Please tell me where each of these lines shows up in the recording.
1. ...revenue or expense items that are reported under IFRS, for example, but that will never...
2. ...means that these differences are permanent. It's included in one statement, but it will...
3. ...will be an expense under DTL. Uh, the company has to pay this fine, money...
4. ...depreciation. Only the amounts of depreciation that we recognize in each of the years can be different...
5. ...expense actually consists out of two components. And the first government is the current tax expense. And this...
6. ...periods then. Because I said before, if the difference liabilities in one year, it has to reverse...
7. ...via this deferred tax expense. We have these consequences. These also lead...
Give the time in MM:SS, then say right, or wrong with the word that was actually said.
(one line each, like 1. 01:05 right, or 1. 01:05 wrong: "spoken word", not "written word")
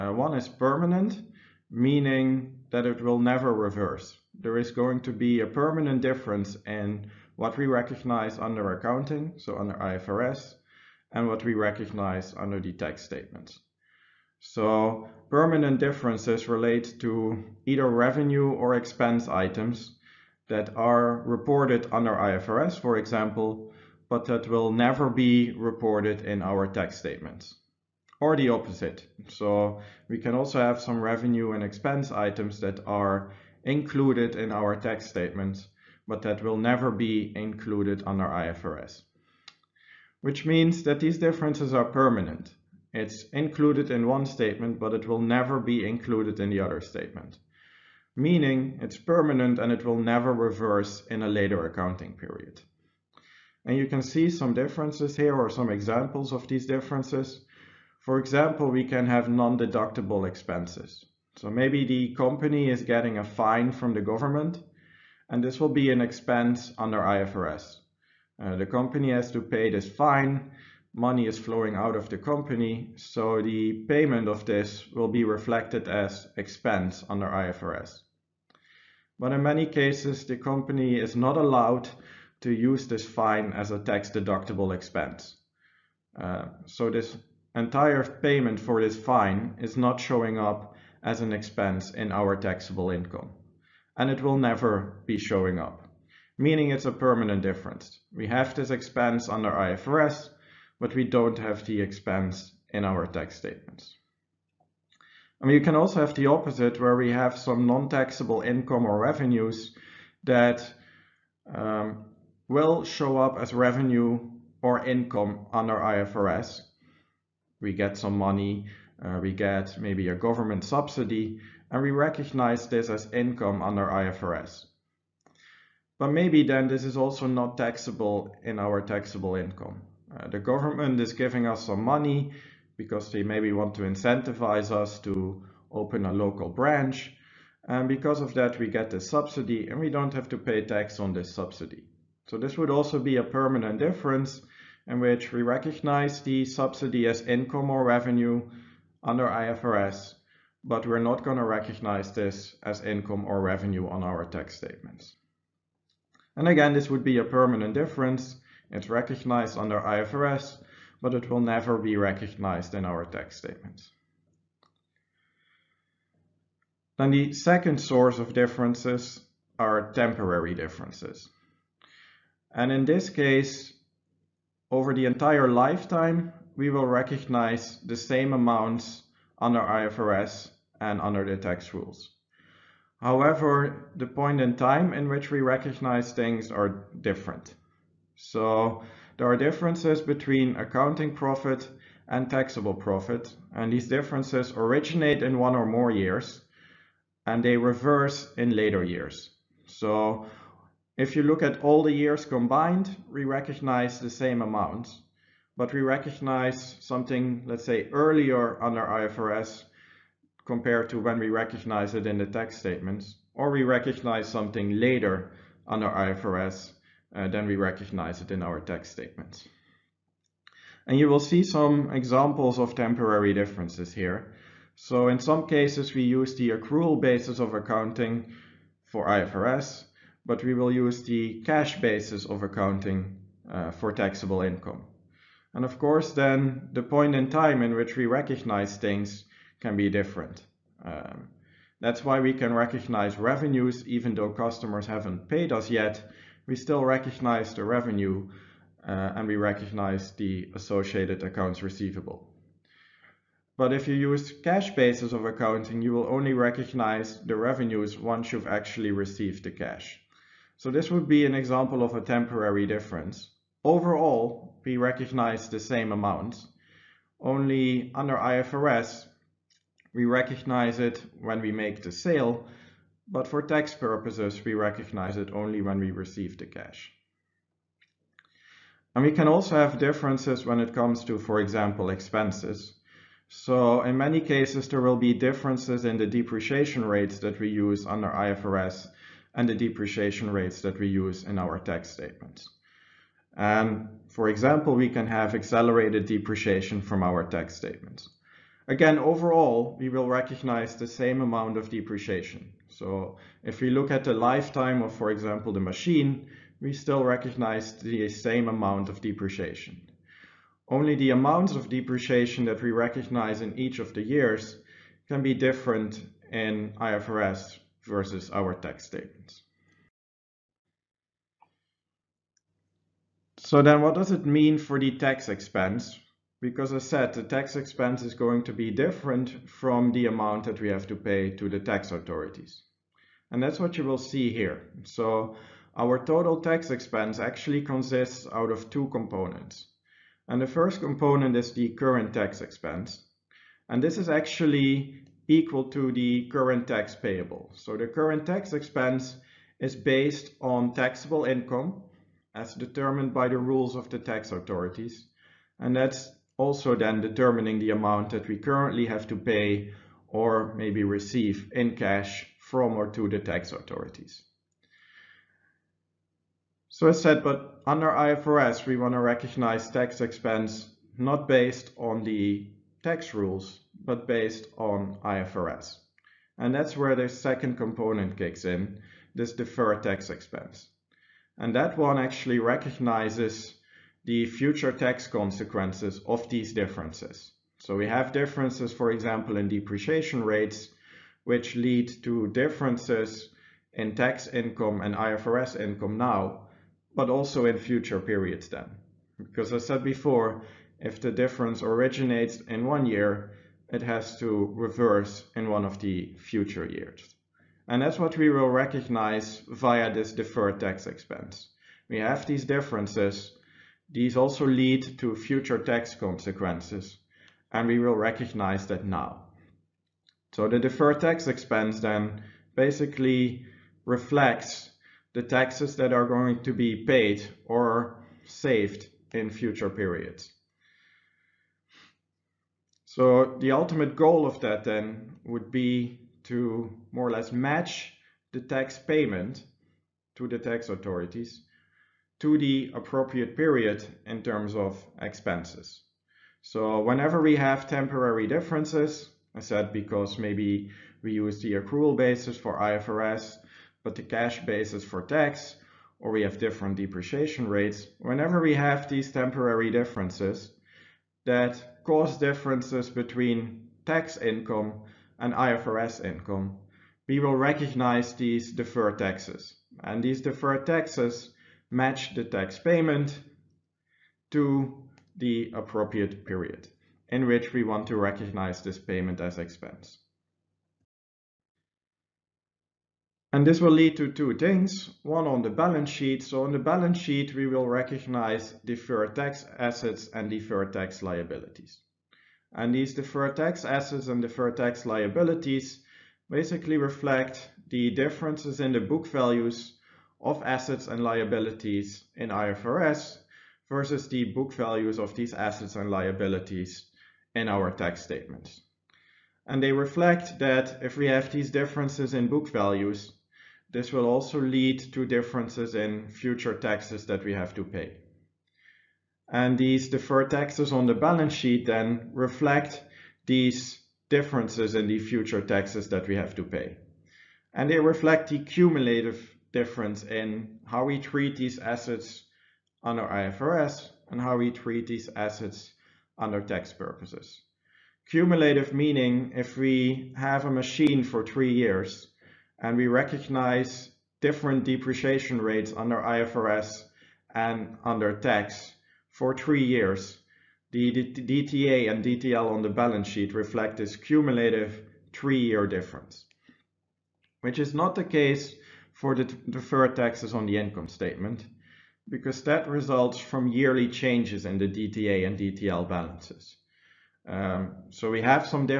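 1. 00:17 right
2. 00:40 right
3. 01:05 wrong: "IFRS", not "DTL"
4. 05:09 right
5. 05:36 wrong: "component", not "government"
6. 06:37 wrong: "originates", not "liabilities"
7. 06:49 wrong: "differences", not "consequences".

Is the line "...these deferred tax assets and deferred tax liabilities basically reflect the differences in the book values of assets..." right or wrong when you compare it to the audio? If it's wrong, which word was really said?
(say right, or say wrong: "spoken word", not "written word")
right.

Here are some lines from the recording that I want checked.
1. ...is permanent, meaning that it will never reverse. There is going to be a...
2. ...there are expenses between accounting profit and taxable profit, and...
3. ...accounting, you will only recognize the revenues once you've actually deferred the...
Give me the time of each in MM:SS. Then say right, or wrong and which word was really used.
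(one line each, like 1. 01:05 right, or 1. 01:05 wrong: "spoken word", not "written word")
1. 00:00 right
2. 03:09 wrong: "differences", not "expenses"
3. 04:15 wrong: "received", not "deferred".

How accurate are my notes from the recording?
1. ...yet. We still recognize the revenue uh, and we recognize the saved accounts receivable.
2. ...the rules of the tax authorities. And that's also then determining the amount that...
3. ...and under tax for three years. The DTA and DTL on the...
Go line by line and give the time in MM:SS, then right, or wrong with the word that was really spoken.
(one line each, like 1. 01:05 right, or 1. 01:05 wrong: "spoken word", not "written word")
1. 04:05 wrong: "associated", not "saved"
2. 05:53 right
3. 09:07 right.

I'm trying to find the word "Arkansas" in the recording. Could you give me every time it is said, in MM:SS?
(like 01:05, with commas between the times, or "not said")
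not said.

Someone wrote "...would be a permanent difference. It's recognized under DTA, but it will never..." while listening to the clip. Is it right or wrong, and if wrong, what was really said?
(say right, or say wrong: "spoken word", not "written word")
wrong: "IFRS", not "DTA".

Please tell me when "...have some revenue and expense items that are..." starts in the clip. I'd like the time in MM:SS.
00:30.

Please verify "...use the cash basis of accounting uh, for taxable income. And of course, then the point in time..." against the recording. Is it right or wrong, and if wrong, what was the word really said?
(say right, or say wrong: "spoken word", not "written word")
right.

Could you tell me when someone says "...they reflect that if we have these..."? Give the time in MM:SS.
08:29.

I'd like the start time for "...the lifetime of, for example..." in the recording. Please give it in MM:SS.
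05:04.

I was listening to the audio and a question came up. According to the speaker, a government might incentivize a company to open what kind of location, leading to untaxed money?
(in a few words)
A local branch.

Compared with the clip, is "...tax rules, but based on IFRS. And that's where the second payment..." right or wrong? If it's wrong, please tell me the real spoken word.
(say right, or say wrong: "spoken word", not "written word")
wrong: "component", not "payment".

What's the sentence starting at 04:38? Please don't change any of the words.
And we can also have differences when it comes to, for example, expenses.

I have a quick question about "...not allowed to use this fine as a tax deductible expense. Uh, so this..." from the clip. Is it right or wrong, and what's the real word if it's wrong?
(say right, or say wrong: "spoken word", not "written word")
right.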